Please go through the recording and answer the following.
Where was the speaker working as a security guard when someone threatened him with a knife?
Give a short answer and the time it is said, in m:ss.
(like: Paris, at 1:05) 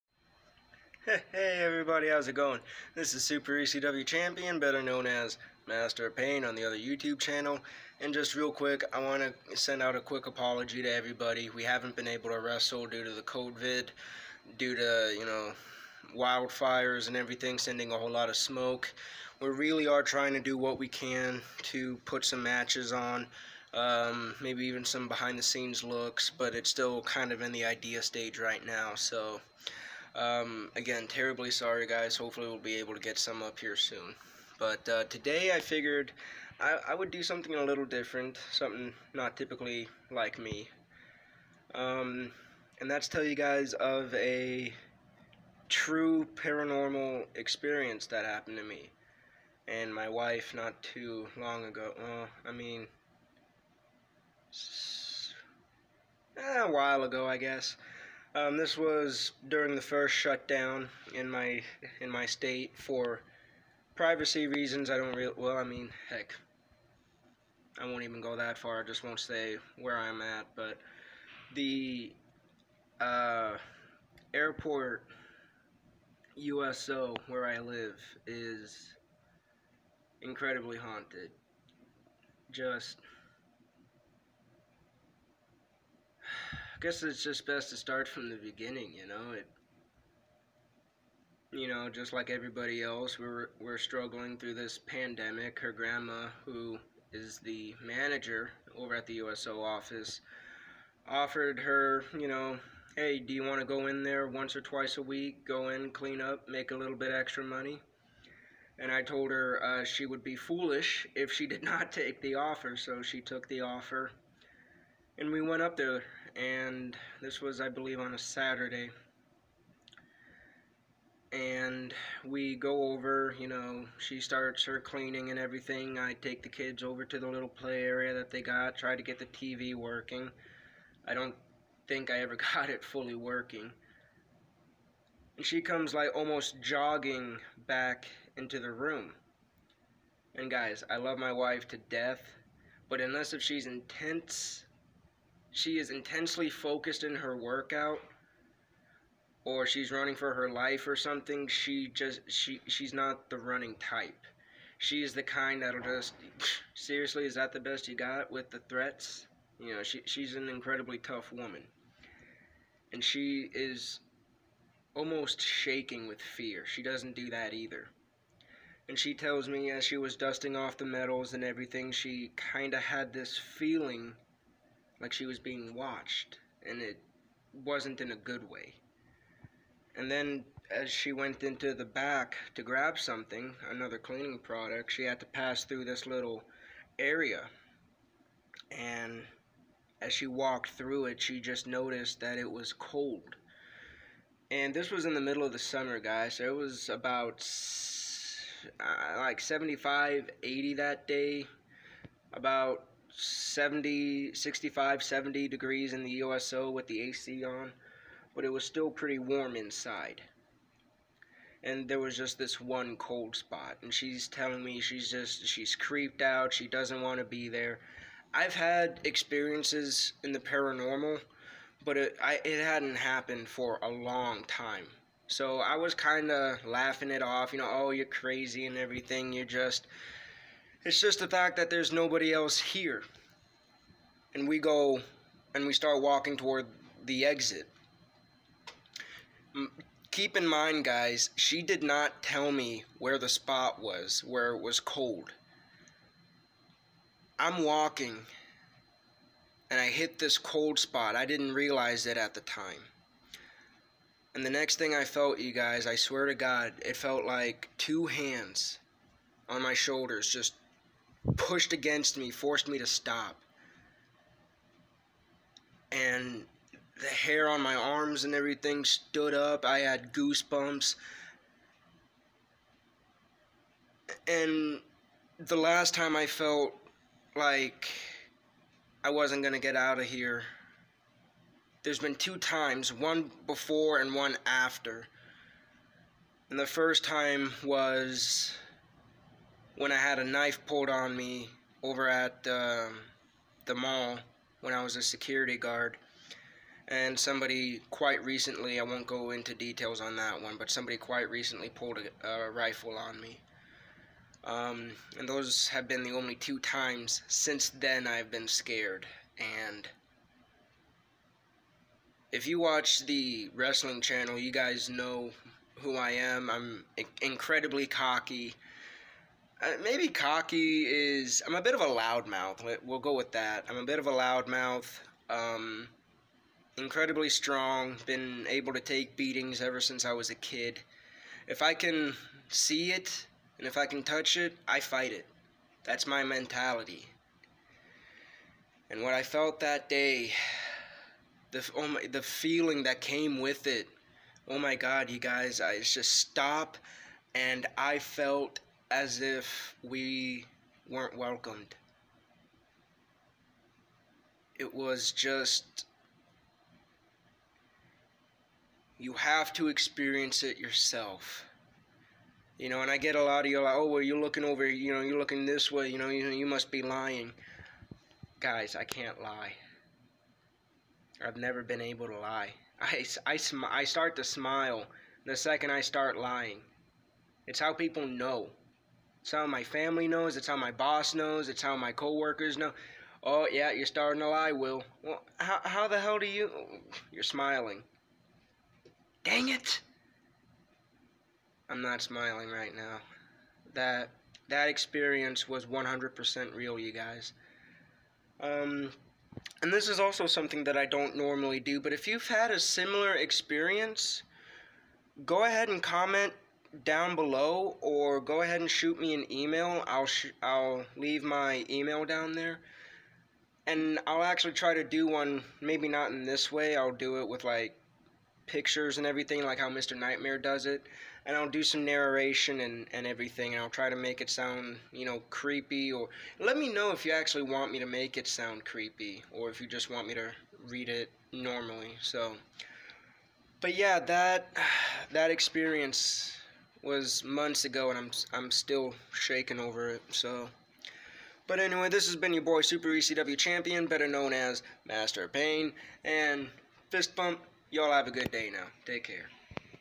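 The mall, at 4:53.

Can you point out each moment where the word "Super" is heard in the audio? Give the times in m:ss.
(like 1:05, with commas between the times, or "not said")
0:03, 7:22.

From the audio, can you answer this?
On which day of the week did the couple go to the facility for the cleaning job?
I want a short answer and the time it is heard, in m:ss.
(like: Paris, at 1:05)
Saturday, at 1:58.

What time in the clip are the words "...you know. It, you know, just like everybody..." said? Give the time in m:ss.
1:28.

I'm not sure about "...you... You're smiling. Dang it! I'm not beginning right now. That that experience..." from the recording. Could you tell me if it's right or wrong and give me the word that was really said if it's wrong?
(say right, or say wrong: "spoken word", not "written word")
wrong: "smiling", not "beginning".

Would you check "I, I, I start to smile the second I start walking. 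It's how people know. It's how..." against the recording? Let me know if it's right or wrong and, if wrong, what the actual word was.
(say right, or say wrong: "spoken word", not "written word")
wrong: "lying", not "walking".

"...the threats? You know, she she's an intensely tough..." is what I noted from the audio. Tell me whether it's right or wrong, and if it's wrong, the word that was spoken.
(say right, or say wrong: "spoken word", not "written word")
wrong: "incredibly", not "intensely".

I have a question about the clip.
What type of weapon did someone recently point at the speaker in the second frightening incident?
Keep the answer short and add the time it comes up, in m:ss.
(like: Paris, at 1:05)
A rifle, at 5:02.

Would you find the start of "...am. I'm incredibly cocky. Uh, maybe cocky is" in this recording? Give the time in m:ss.
5:16.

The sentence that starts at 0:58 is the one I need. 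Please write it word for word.
Um, this was during the first shutdown in my in my state for privacy reasons.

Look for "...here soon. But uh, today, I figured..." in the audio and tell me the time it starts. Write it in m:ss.
0:33.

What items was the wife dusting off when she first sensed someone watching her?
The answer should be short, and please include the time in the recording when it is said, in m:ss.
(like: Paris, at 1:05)
Medals, at 2:50.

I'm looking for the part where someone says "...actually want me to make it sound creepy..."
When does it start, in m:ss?
7:07.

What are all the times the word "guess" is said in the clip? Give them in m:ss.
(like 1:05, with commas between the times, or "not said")
0:57, 1:26.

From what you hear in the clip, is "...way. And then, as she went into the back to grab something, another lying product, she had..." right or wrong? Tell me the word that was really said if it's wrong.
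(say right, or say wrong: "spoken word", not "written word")
wrong: "cleaning", not "lying".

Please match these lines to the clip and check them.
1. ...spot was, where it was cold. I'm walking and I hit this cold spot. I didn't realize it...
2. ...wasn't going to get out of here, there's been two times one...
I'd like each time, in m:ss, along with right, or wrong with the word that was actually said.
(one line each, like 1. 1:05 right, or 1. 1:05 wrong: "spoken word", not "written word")
1. 4:03 right
2. 4:39 right.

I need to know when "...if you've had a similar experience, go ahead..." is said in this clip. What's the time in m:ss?
6:41.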